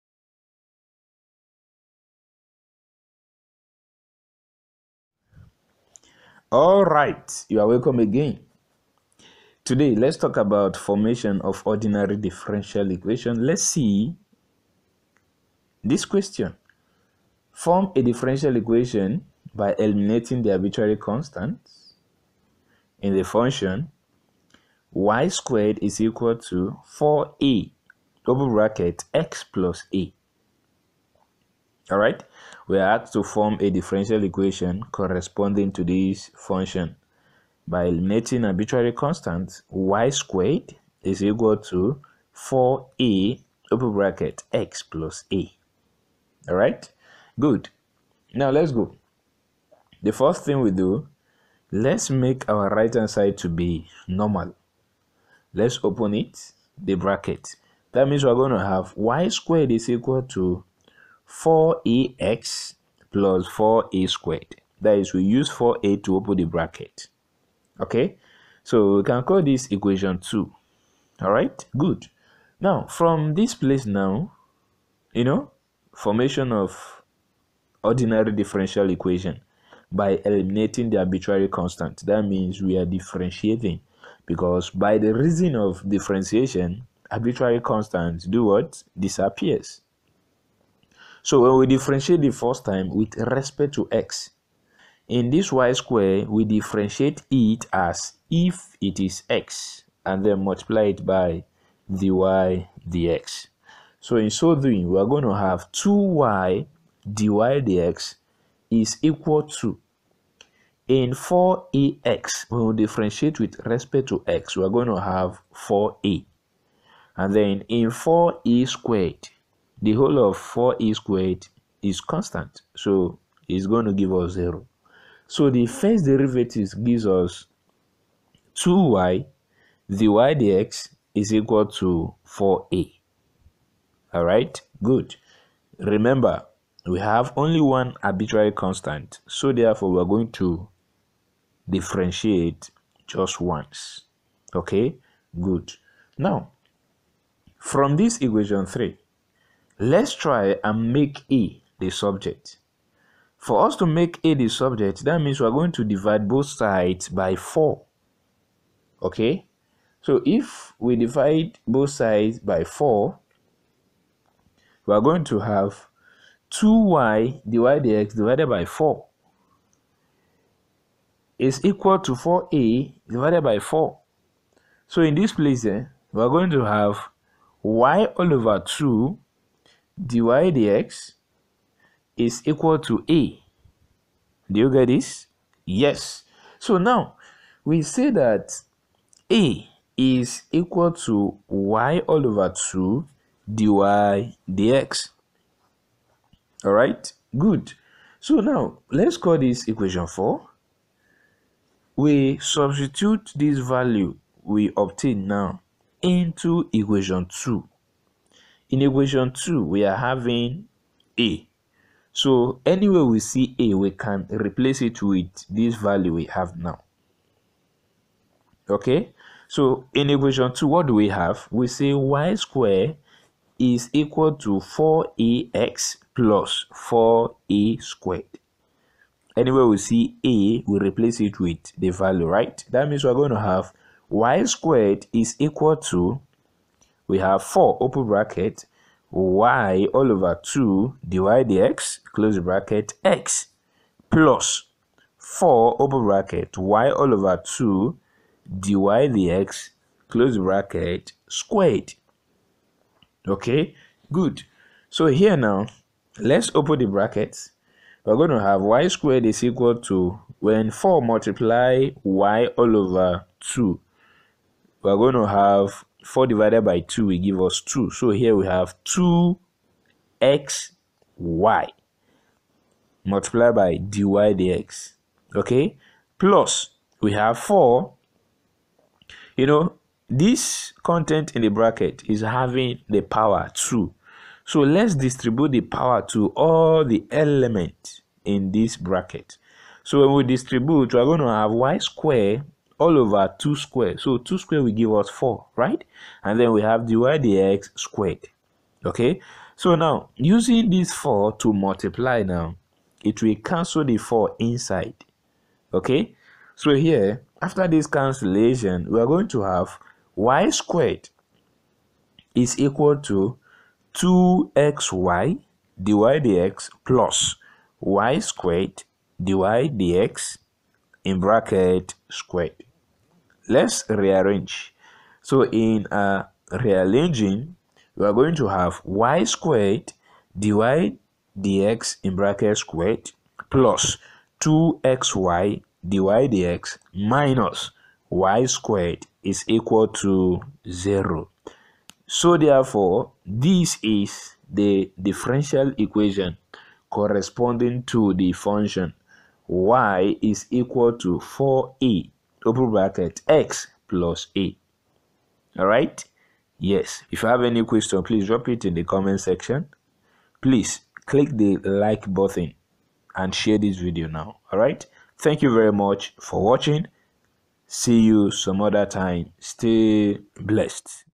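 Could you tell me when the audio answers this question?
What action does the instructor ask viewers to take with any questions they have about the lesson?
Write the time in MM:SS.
05:58.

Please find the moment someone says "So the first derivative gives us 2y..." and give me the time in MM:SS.
02:05.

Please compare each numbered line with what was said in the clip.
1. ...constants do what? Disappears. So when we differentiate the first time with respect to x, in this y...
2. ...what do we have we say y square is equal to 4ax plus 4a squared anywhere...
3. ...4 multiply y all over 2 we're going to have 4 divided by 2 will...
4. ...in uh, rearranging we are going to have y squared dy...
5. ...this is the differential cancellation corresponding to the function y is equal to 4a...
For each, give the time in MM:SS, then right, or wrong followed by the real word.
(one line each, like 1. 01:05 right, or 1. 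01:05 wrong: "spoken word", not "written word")
1. 01:27 right
2. 03:40 right
3. 04:20 right
4. 05:25 right
5. 05:43 wrong: "equation", not "cancellation".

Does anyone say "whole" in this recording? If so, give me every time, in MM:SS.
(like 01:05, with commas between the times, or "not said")
01:59.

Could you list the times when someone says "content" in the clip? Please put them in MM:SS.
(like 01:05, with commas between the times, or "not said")
04:40.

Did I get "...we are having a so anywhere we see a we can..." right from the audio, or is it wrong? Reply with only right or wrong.
right.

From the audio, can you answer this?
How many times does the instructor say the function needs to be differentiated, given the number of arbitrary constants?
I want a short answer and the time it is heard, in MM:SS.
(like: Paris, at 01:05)
Once, at 02:23.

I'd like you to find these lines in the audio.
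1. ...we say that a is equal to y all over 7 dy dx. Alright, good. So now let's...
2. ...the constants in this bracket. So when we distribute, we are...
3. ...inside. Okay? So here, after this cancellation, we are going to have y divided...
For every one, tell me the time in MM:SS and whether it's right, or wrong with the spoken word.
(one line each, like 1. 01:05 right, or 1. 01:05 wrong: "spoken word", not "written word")
1. 03:07 wrong: "2", not "7"
2. 04:46 wrong: "elements", not "constants"
3. 05:04 wrong: "squared", not "divided".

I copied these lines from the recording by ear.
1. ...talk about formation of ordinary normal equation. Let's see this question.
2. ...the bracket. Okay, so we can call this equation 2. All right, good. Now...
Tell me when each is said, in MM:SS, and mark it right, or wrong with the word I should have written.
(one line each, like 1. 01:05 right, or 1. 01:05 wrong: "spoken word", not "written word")
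1. 00:10 wrong: "differential", not "normal"
2. 01:06 right.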